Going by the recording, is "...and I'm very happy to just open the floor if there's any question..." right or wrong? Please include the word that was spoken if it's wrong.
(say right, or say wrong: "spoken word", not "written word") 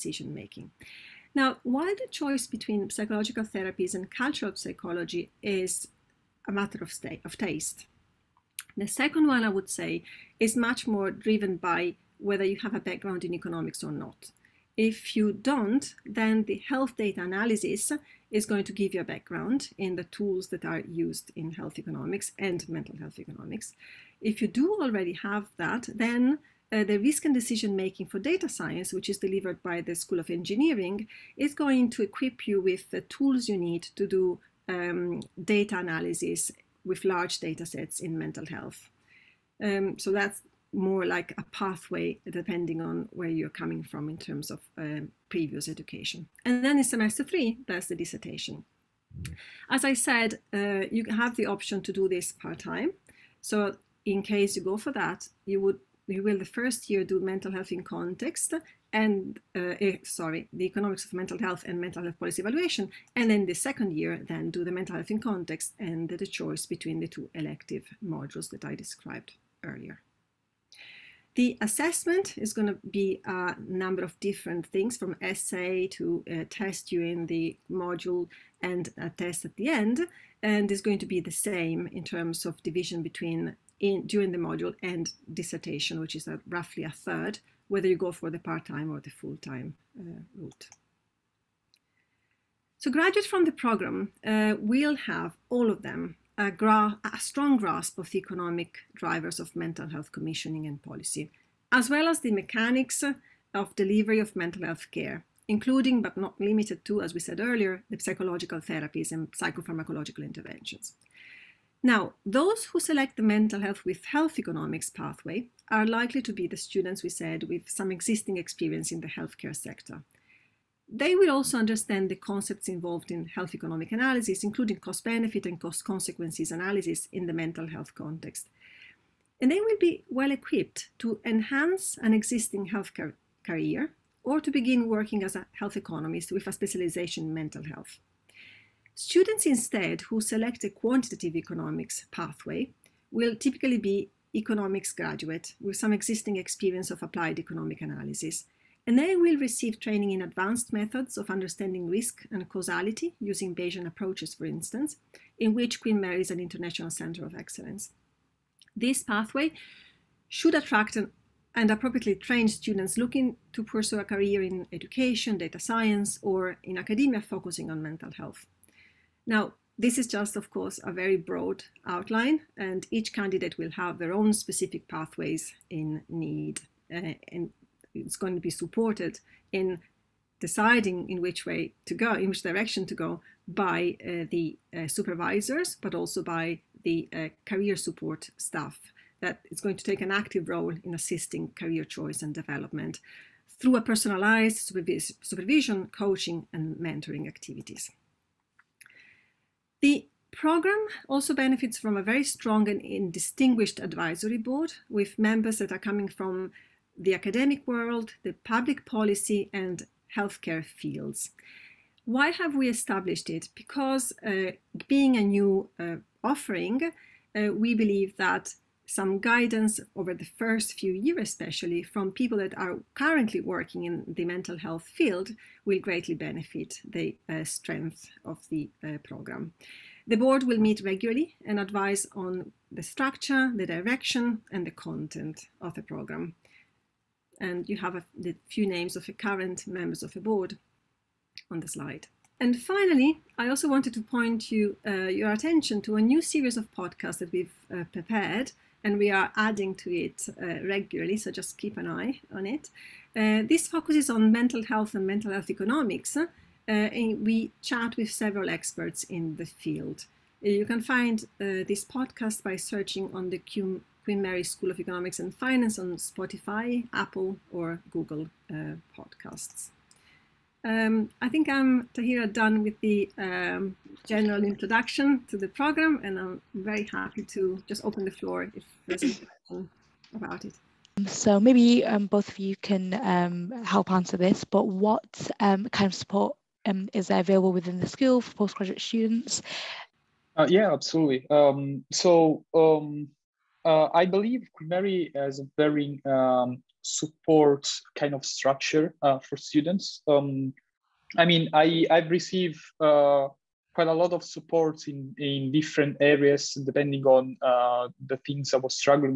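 right.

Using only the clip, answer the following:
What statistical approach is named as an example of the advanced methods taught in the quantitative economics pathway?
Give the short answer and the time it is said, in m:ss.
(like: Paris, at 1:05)
Bayesian approaches, at 2:33.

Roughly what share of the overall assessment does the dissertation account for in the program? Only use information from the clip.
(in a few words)
a third.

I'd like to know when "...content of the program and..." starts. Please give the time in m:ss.
3:54.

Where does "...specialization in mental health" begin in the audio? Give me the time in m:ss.
2:16.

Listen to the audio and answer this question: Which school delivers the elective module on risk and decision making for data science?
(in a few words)
School of Engineering.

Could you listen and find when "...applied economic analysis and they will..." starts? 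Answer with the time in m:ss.
2:27.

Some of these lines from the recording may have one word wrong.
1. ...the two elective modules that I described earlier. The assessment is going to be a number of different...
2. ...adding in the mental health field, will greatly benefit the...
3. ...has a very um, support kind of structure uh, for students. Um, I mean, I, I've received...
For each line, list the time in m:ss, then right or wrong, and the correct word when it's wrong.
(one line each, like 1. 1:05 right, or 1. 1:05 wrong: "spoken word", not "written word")
1. 1:06 right
2. 3:43 wrong: "working", not "adding"
3. 4:55 right.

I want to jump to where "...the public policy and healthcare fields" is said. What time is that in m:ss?
3:28.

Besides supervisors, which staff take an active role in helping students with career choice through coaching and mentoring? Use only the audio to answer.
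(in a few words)
career support staff.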